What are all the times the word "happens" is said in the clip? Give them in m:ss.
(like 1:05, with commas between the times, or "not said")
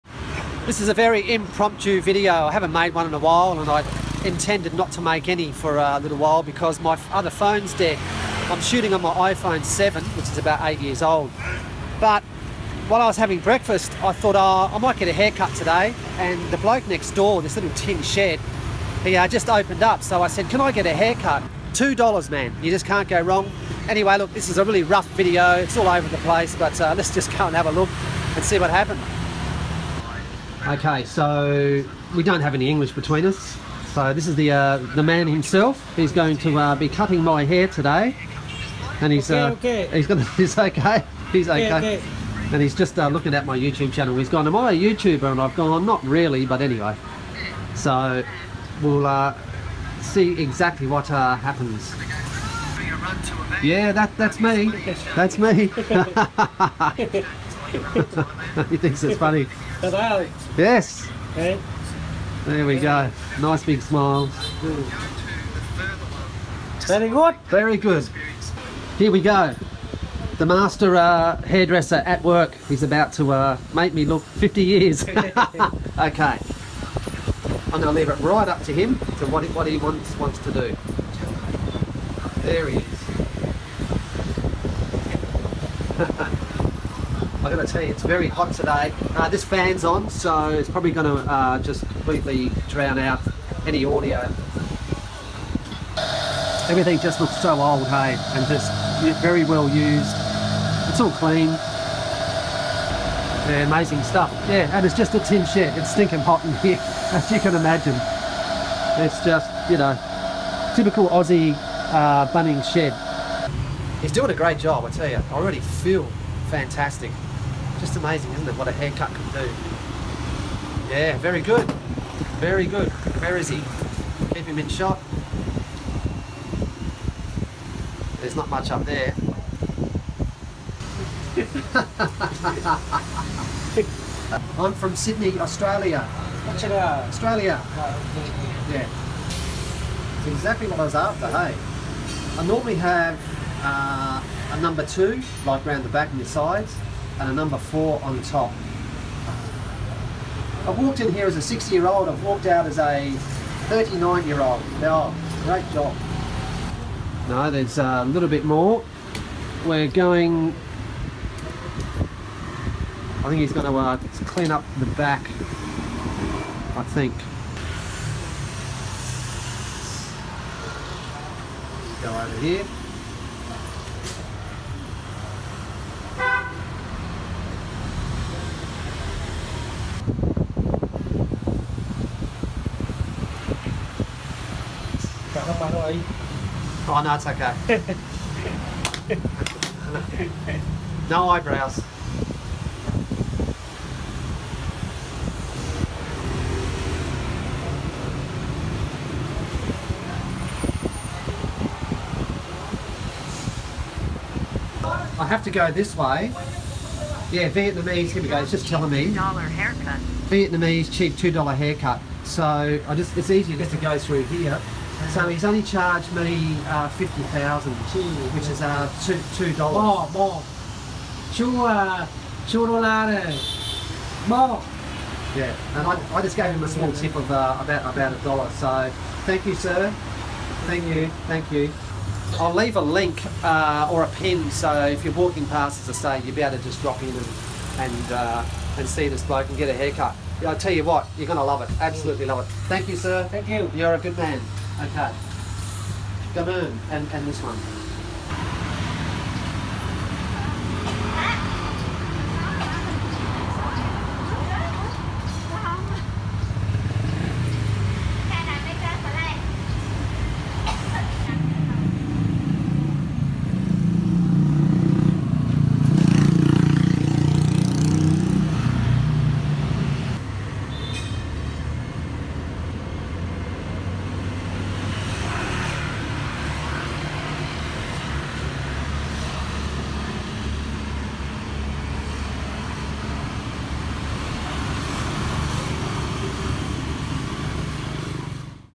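0:28, 0:51.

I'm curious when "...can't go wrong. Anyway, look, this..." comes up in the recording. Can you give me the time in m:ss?
0:22.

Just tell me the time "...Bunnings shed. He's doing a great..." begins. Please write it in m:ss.
1:52.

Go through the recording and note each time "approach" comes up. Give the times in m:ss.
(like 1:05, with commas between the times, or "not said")
not said.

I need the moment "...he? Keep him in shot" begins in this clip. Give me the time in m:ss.
2:03.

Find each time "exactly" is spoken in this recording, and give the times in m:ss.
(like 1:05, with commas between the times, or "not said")
0:50, 2:20.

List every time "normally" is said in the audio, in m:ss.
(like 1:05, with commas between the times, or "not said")
2:22.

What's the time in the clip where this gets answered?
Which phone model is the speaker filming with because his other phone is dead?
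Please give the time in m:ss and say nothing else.
0:09.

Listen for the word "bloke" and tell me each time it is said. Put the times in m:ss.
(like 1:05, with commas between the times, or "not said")
0:16, 3:59.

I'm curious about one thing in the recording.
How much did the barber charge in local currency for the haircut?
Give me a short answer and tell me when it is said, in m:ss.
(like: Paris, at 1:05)
50,000, at 3:36.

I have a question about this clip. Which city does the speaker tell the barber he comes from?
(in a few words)
Sydney.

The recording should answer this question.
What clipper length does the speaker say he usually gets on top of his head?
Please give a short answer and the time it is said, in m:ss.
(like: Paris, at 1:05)
number 4, at 2:27.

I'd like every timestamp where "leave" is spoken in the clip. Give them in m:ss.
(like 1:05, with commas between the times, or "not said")
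1:17, 3:52.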